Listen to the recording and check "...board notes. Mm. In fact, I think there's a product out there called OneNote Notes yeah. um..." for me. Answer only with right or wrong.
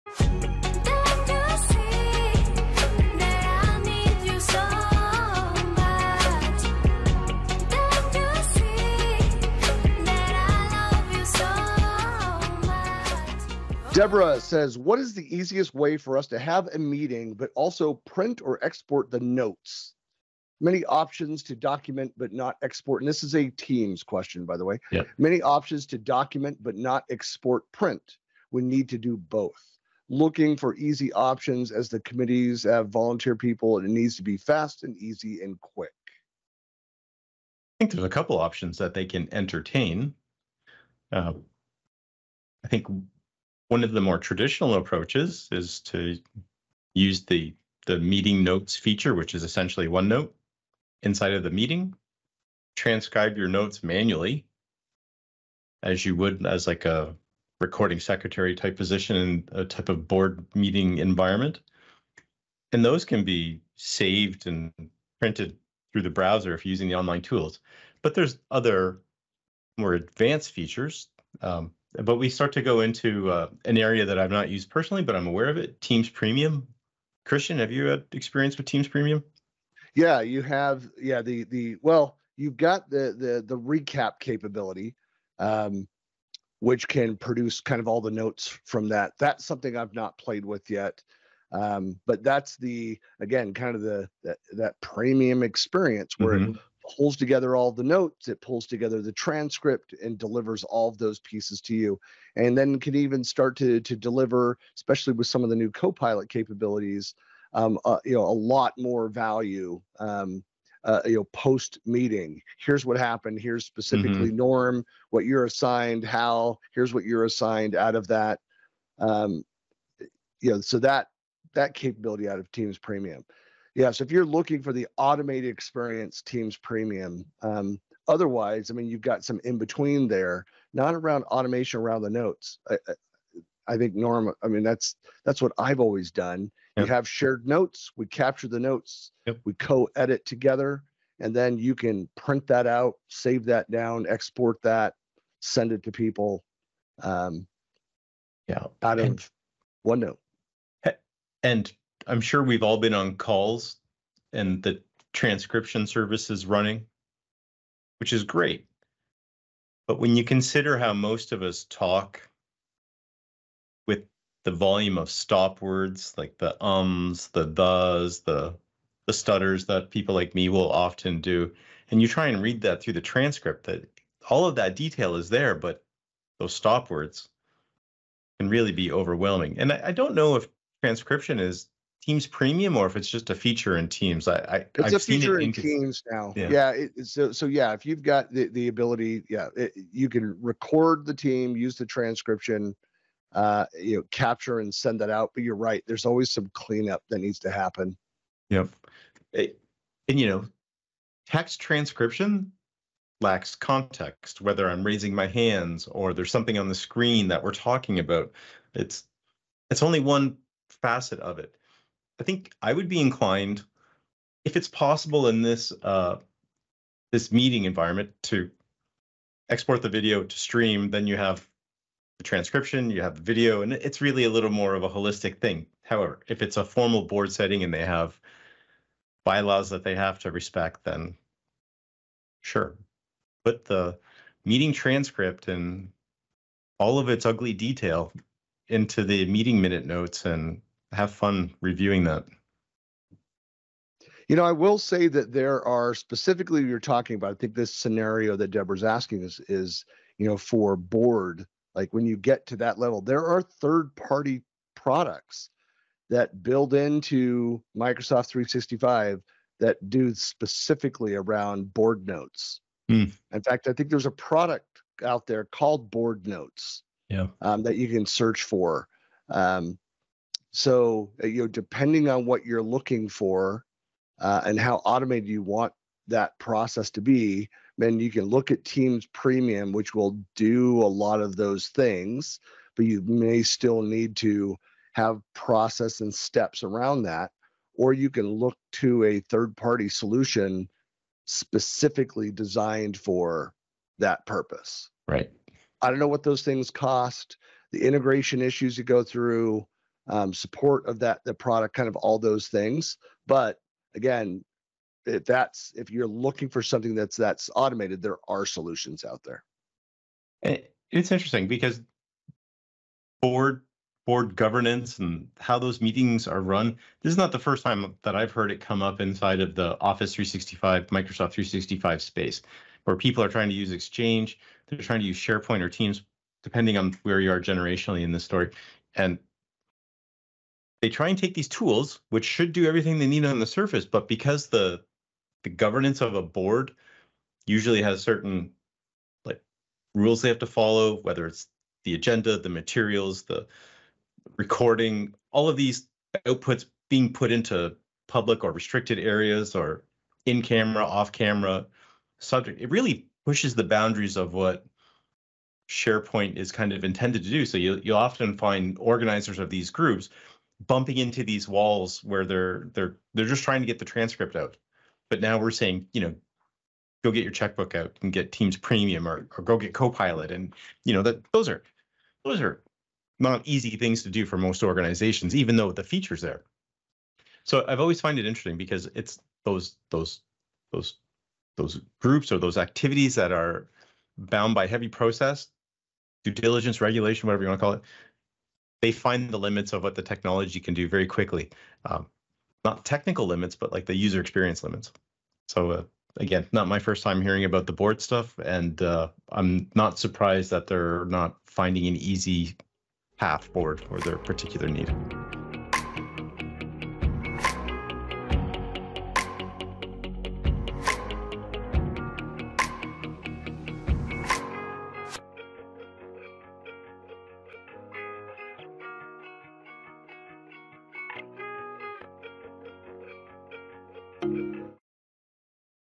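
wrong.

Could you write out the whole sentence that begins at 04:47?
Or you can look to a third party solution specifically designed for that purpose.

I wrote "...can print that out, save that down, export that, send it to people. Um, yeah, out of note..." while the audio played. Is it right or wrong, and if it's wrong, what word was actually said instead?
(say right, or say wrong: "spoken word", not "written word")
right.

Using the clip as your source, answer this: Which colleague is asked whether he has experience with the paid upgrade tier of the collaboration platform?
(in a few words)
Christian.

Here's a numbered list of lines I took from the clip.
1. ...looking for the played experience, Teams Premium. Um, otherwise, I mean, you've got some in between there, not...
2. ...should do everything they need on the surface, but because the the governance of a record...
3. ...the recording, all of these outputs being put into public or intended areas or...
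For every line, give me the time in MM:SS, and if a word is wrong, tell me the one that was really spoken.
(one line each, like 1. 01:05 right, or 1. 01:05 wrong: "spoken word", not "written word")
1. 02:04 wrong: "automated", not "played"
2. 05:32 wrong: "board", not "record"
3. 05:43 wrong: "restricted", not "intended".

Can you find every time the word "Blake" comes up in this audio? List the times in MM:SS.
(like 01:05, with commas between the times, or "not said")
not said.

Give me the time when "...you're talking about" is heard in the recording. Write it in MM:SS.
04:06.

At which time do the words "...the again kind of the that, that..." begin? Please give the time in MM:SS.
01:32.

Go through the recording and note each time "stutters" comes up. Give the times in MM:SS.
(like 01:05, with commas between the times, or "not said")
02:49.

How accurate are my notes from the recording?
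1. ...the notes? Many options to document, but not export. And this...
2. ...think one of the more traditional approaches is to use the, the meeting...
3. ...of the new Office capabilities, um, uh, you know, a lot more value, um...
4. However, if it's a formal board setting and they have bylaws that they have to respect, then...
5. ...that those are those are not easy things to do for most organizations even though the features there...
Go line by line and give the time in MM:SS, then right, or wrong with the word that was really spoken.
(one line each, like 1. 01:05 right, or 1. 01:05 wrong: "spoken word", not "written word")
1. 00:19 right
2. 00:42 right
3. 01:45 wrong: "Copilot", not "Office"
4. 03:45 right
5. 06:11 right.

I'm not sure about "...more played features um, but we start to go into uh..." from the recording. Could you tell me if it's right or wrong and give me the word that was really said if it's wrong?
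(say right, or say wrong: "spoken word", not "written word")
wrong: "advanced", not "played".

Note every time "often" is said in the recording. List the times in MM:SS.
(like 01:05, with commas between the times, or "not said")
02:50, 05:57.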